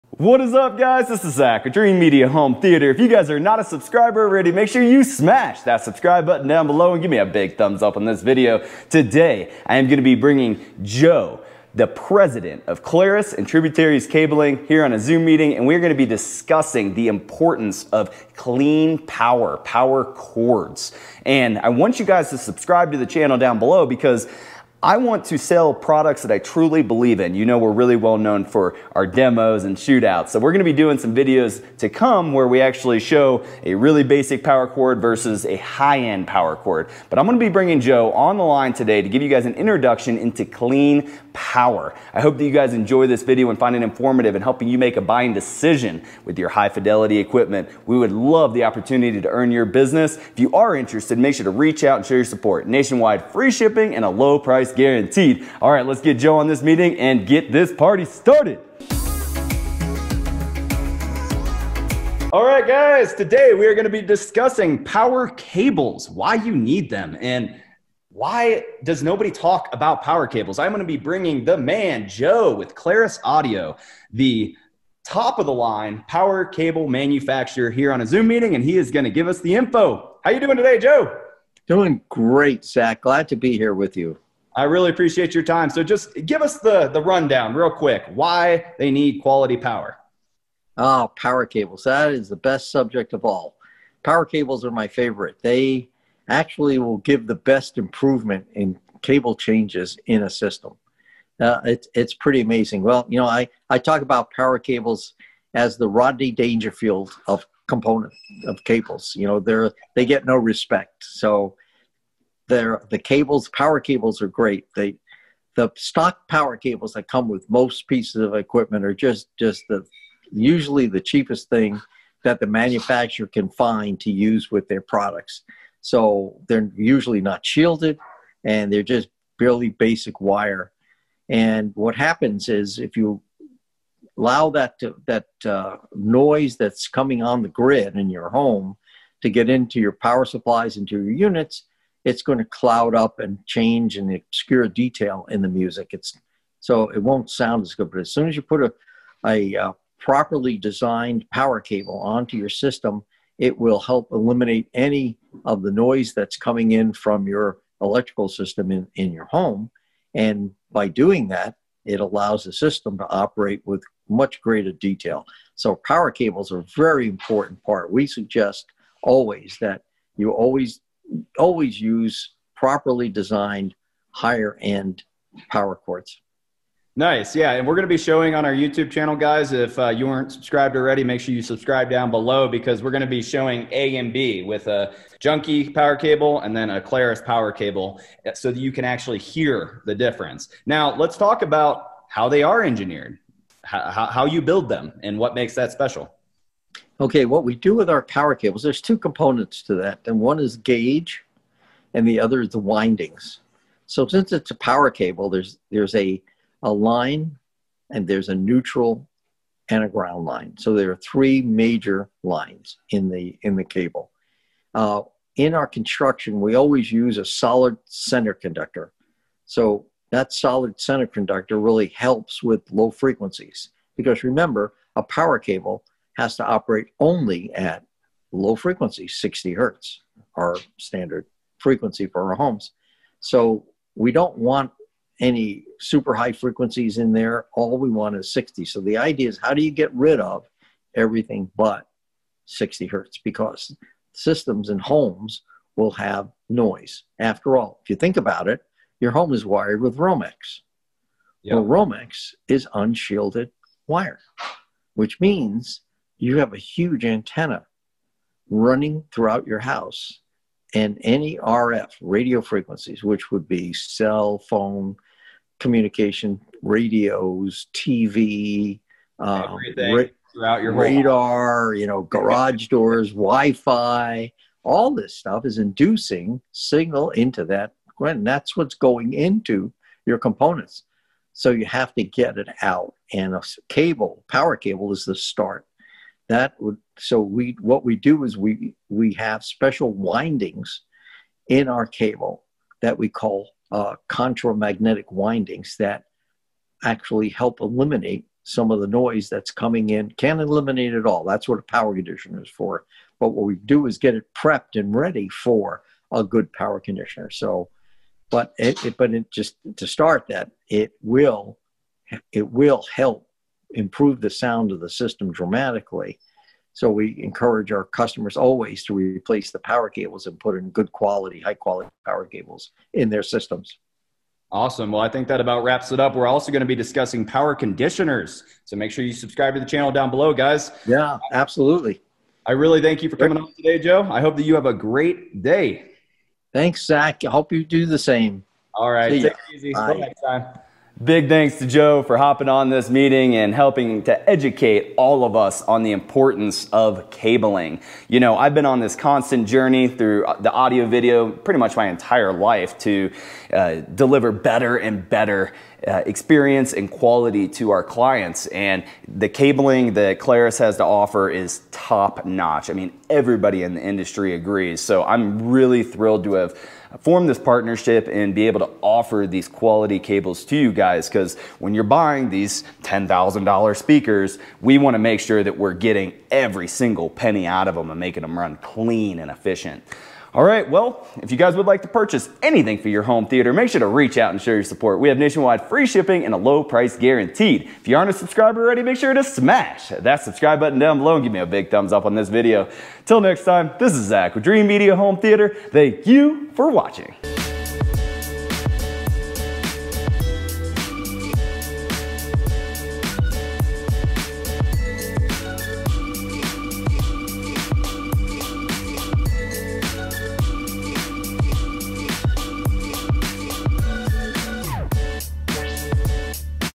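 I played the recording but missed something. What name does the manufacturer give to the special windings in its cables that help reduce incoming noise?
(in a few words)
Contramagnetic windings.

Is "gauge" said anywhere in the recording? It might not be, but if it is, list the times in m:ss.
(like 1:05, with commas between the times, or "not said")
3:20.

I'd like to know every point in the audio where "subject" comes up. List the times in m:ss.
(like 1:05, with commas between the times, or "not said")
1:32.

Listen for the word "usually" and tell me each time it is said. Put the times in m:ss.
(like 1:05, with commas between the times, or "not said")
2:00, 2:06.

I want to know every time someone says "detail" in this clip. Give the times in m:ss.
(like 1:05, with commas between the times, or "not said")
2:24, 2:44.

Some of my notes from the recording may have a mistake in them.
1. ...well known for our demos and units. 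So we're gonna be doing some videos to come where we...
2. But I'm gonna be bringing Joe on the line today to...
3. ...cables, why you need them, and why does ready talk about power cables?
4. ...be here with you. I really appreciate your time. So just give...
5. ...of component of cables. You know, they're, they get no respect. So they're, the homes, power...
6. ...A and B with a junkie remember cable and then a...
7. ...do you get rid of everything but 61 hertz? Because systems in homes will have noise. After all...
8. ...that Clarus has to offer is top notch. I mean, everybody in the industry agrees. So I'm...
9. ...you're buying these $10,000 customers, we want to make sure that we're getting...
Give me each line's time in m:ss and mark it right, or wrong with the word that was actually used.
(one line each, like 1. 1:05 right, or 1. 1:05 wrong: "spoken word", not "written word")
1. 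0:27 wrong: "shootouts", not "units"
2. 0:37 right
3. 1:05 wrong: "nobody", not "ready"
4. 1:23 right
5. 1:47 wrong: "cables", not "homes"
6. 3:03 wrong: "power", not "remember"
7. 3:59 wrong: "60", not "61"
8. 5:59 right
9. 6:11 wrong: "speakers", not "customers".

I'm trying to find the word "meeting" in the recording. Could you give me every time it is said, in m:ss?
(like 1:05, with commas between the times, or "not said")
0:15, 0:56, 1:18, 5:42.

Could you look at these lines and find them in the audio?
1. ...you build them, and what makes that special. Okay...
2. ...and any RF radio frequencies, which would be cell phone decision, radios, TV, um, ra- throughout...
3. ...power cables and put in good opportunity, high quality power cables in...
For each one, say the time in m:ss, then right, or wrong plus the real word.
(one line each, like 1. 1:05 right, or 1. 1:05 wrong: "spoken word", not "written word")
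1. 3:14 right
2. 4:20 wrong: "communication", not "decision"
3. 5:19 wrong: "quality", not "opportunity".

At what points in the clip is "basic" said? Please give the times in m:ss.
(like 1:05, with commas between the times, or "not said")
0:34, 2:09.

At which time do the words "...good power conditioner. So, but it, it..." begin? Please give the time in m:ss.
5:06.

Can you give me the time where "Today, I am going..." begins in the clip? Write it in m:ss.
0:08.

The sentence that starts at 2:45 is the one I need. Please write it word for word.
So, power cables are a very important part.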